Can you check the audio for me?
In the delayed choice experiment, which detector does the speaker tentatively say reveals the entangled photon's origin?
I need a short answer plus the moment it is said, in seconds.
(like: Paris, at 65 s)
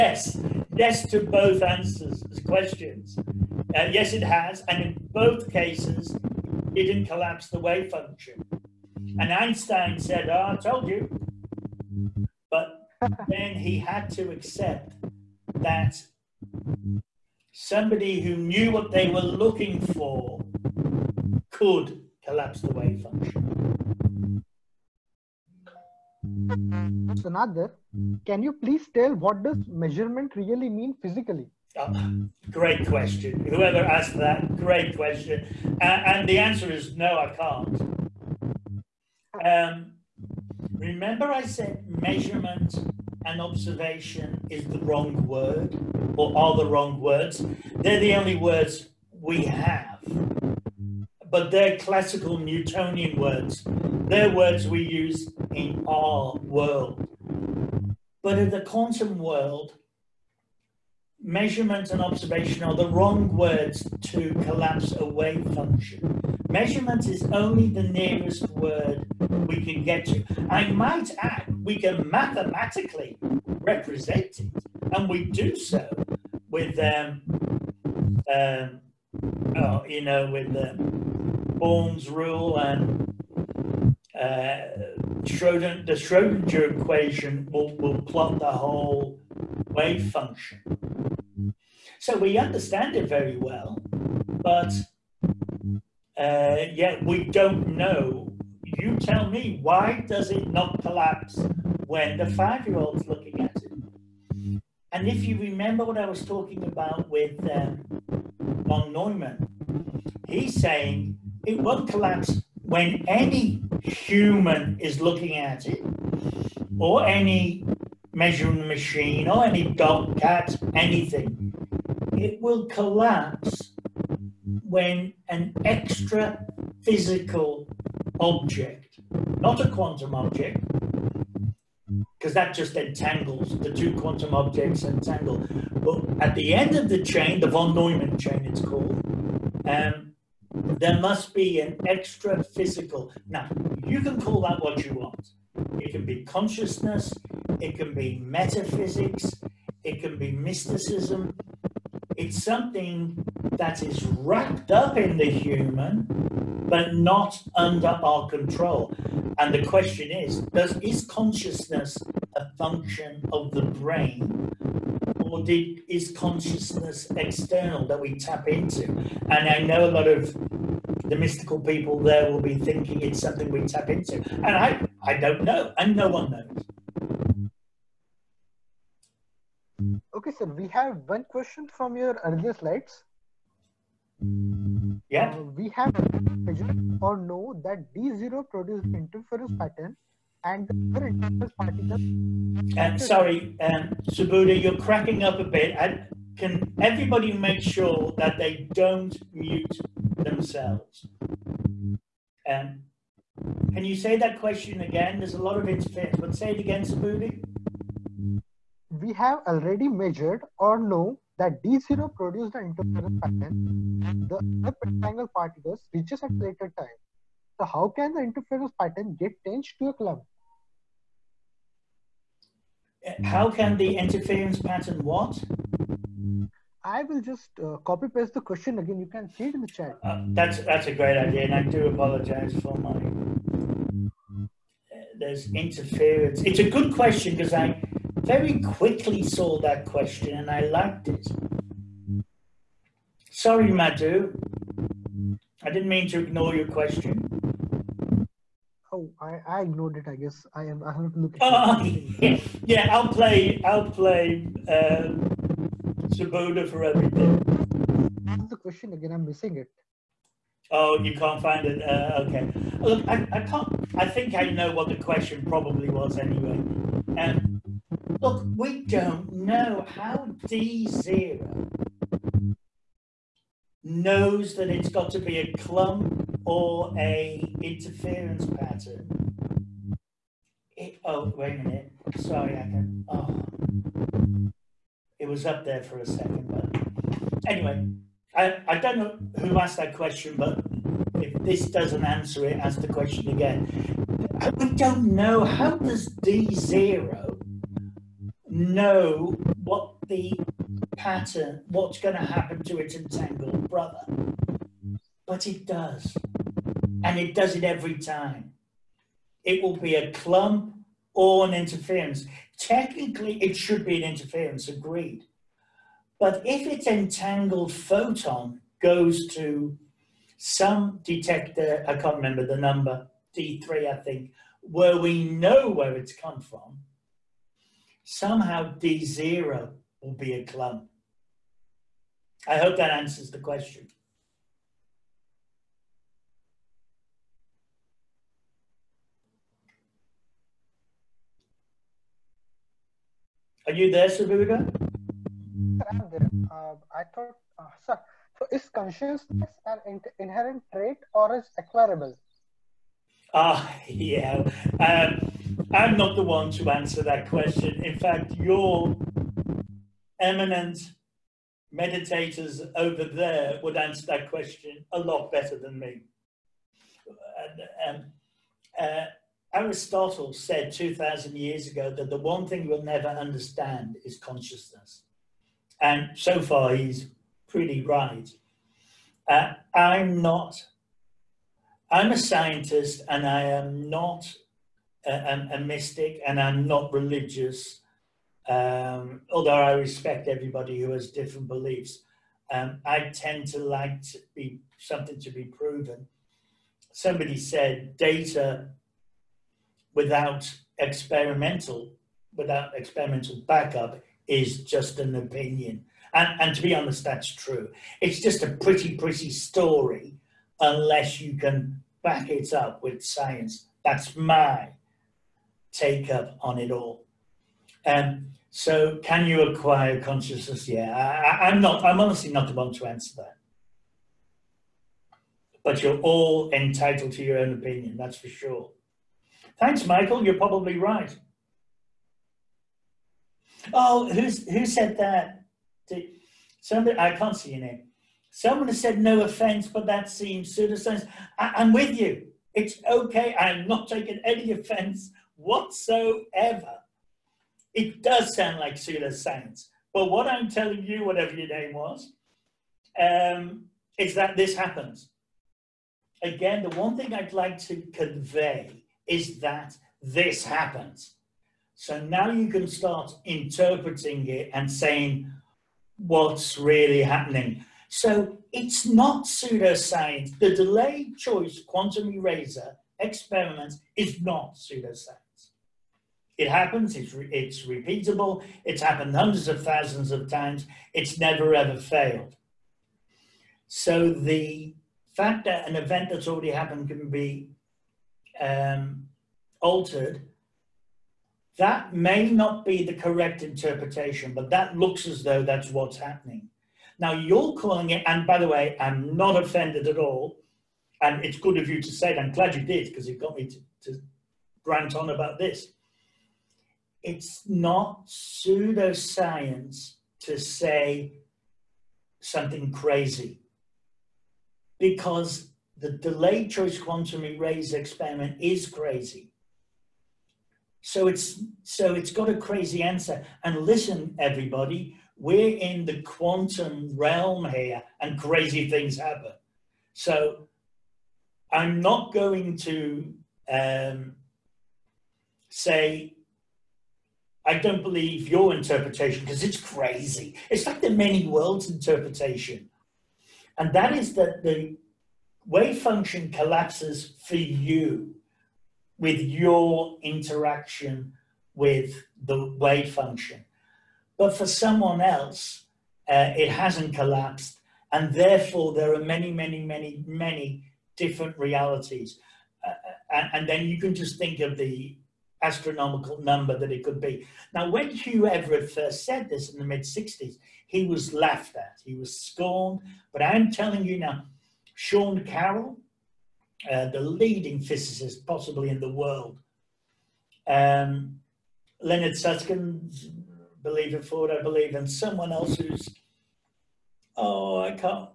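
D3, at 323 s.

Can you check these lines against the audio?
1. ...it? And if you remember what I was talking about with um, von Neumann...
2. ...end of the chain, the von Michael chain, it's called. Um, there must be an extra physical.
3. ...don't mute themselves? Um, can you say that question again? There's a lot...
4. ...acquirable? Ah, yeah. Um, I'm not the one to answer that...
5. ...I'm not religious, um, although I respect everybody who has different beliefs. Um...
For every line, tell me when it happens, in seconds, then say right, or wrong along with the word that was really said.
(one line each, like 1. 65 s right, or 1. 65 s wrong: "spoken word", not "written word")
1. 103 s right
2. 136 s wrong: "Neumann", not "Michael"
3. 198 s right
4. 351 s right
5. 386 s right.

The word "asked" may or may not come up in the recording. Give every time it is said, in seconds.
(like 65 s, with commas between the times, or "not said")
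33 s, 289 s.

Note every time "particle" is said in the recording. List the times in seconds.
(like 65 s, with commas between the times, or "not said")
191 s, 215 s.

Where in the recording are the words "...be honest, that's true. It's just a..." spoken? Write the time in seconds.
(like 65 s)
406 s.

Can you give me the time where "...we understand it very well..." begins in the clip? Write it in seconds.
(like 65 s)
92 s.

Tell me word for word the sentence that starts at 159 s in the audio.
And the question is, does, is consciousness a function of the brain?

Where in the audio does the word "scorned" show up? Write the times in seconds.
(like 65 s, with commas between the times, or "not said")
572 s.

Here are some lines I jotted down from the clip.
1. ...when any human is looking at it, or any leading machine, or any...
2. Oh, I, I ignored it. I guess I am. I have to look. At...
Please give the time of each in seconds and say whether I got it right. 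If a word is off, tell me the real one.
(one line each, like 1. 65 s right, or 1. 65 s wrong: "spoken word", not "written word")
1. 112 s wrong: "measuring", not "leading"
2. 248 s right.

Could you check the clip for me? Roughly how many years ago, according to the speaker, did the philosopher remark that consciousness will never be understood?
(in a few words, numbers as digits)
2,000.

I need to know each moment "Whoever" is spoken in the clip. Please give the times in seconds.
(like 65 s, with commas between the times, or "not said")
33 s.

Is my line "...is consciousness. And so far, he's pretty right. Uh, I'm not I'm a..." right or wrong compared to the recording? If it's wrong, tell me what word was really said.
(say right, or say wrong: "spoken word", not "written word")
right.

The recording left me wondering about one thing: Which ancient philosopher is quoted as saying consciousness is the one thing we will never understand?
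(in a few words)
Aristotle.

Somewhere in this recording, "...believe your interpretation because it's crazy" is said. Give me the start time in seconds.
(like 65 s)
537 s.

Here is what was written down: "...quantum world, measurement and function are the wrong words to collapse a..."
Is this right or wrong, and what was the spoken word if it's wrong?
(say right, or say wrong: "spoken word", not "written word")
wrong: "observation", not "function".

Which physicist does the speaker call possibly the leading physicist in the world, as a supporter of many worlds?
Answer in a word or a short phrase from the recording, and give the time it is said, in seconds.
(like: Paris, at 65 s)
Sean Carroll, at 574 s.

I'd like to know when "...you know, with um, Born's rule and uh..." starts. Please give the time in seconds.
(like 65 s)
79 s.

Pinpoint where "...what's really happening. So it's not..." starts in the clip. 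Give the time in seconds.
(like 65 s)
465 s.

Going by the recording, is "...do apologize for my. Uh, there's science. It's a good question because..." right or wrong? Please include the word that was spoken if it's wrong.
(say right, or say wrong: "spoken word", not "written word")
wrong: "interference", not "science".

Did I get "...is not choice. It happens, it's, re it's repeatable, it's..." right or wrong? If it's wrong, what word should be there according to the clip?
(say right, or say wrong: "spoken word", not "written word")
wrong: "pseudoscience", not "choice".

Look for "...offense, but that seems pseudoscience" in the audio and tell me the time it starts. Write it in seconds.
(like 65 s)
439 s.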